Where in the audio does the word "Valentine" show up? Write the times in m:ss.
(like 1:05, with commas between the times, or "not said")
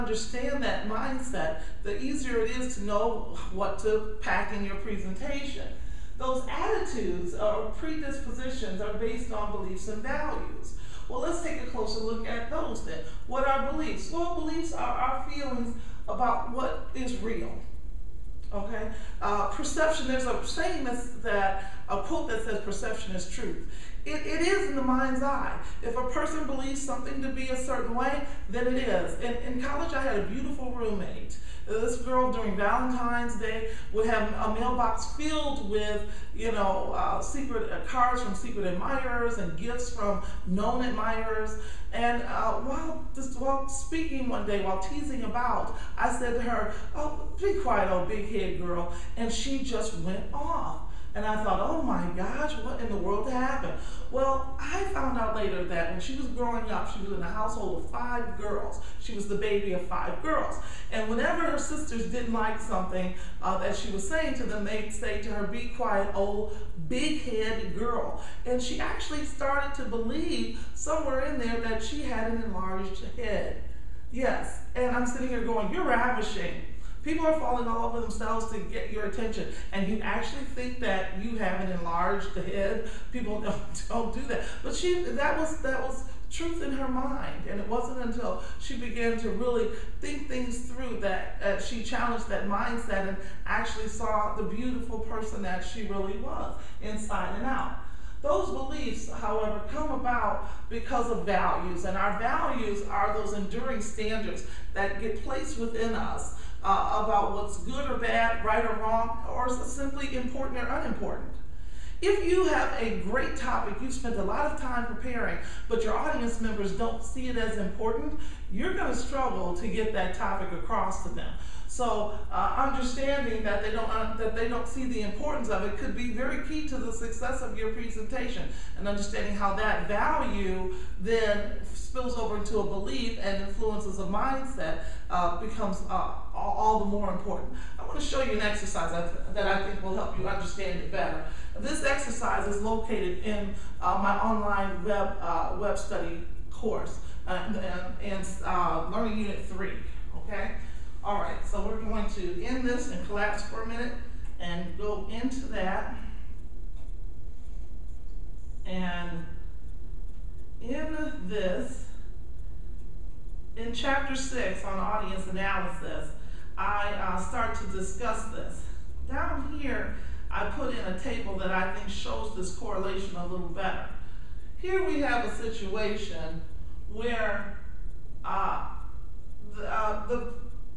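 0:32.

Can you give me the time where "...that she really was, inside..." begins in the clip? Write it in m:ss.
1:35.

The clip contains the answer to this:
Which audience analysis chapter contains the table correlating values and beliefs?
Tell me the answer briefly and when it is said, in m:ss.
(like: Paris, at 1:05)
chapter 6, at 2:43.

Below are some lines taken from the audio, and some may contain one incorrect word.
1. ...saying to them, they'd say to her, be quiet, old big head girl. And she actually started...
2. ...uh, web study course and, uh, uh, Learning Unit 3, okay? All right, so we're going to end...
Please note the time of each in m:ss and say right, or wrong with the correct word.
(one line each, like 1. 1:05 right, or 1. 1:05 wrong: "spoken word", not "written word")
1. 1:04 right
2. 2:25 right.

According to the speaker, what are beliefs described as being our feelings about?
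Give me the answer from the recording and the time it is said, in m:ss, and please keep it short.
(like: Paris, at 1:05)
what is real, at 0:16.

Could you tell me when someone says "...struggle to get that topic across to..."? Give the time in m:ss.
1:58.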